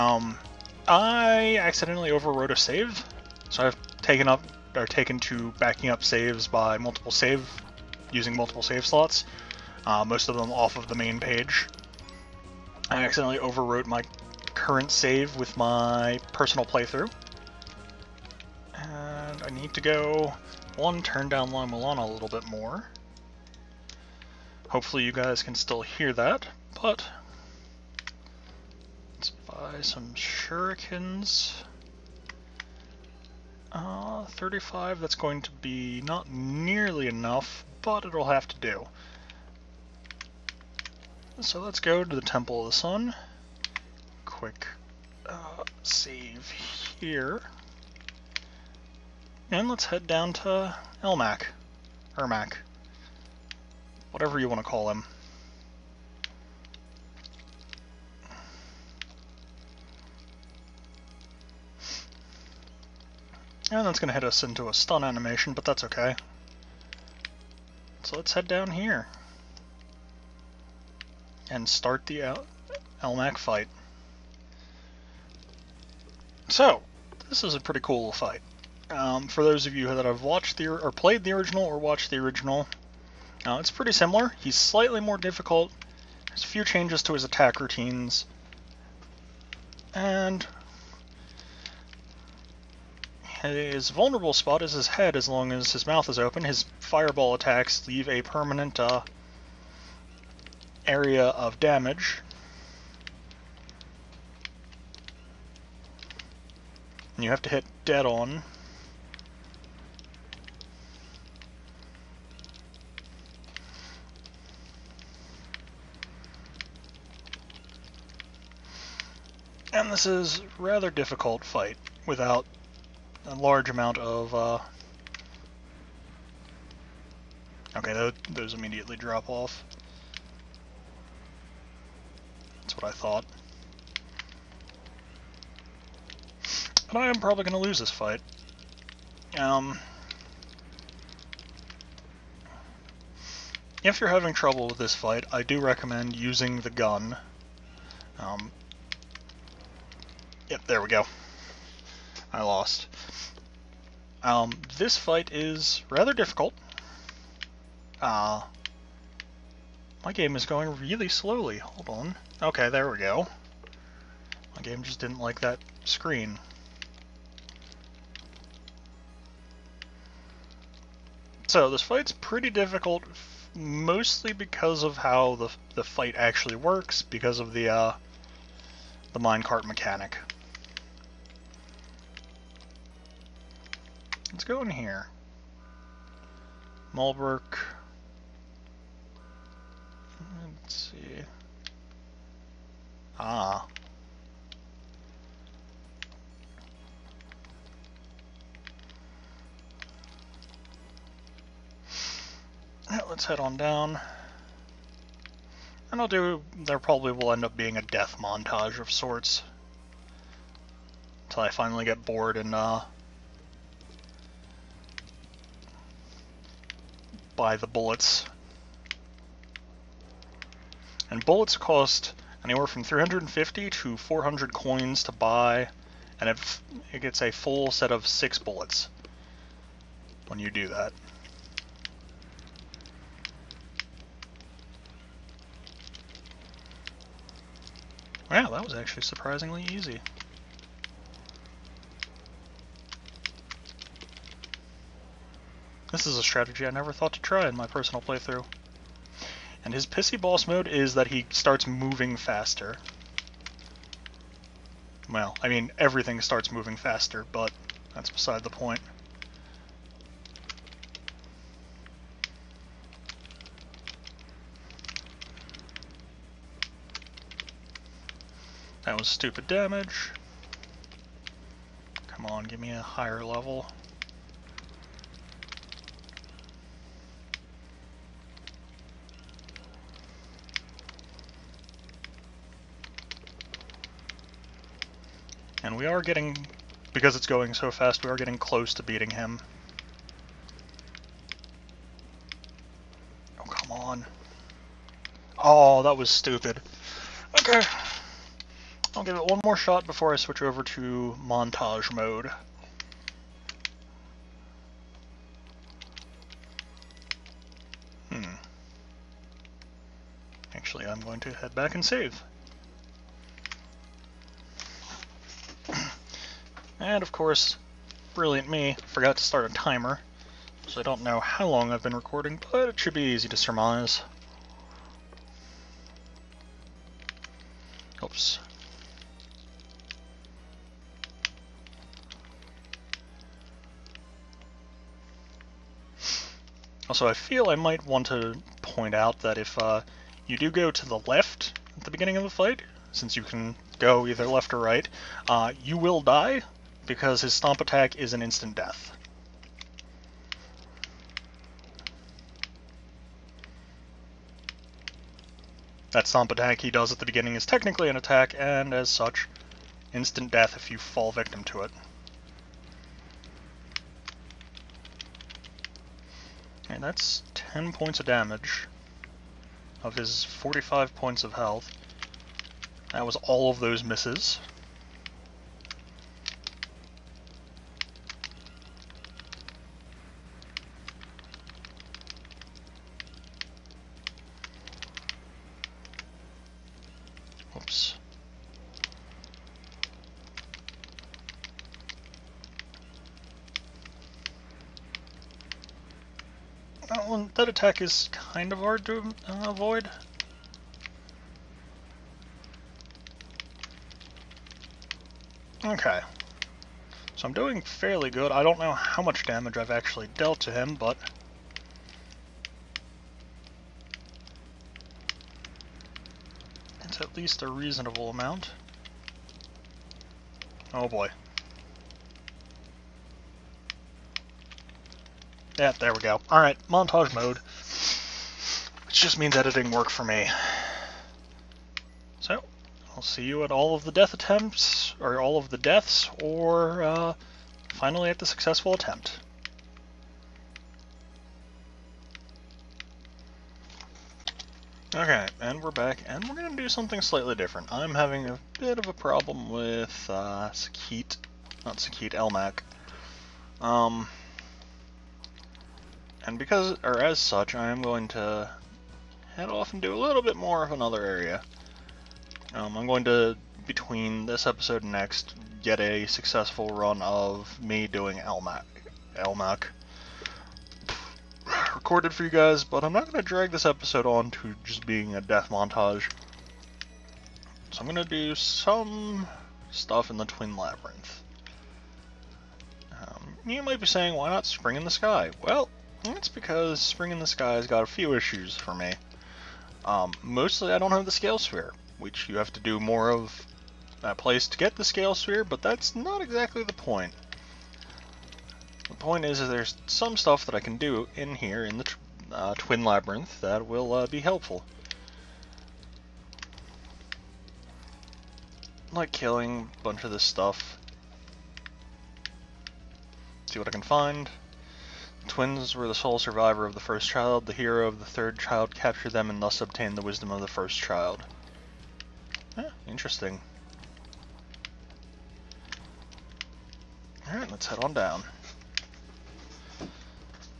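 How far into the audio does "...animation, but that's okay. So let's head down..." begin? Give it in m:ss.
1:05.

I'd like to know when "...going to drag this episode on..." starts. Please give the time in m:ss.
7:53.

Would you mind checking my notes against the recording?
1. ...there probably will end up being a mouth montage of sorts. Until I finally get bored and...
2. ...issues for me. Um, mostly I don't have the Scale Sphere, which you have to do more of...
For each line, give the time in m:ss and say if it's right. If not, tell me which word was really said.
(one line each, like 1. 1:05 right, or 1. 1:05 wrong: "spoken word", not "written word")
1. 3:26 wrong: "death", not "mouth"
2. 8:08 right.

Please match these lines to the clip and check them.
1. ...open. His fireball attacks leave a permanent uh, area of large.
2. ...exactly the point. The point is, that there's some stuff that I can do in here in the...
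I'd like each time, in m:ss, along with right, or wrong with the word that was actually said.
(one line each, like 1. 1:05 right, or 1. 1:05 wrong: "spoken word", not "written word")
1. 1:36 wrong: "damage", not "large"
2. 8:16 right.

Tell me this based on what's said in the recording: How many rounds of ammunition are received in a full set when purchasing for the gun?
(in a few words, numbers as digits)
six.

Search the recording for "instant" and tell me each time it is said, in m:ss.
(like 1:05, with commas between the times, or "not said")
5:48, 5:59.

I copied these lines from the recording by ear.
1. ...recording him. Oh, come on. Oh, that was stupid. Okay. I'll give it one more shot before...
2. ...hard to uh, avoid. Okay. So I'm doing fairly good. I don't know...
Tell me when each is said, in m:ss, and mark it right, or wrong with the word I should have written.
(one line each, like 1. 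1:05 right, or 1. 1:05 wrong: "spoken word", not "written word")
1. 4:48 wrong: "beating", not "recording"
2. 6:38 right.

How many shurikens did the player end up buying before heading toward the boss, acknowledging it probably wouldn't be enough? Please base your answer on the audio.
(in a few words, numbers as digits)
35.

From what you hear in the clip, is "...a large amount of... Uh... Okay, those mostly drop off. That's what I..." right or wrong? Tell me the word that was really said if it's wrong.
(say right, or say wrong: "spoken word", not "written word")
wrong: "immediately", not "mostly".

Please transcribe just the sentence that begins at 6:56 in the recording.
It's at least a reasonable amount.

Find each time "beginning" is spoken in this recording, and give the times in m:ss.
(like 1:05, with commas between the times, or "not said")
5:41, 5:57.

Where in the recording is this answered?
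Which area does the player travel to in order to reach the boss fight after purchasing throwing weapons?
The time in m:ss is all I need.
0:42.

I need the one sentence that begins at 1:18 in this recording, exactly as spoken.
Um, for those of you that have watched the or played the original or watched the original, uh, it's pretty similar.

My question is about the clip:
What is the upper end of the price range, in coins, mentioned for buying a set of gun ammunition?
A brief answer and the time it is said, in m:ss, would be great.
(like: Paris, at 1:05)
400, at 3:43.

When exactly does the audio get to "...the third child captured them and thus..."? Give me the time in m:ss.
8:37.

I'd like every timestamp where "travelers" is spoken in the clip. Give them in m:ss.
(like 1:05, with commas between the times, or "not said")
not said.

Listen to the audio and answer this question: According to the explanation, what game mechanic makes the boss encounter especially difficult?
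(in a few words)
minecart mechanic.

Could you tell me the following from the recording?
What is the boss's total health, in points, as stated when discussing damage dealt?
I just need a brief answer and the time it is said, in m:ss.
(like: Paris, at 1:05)
45, at 6:10.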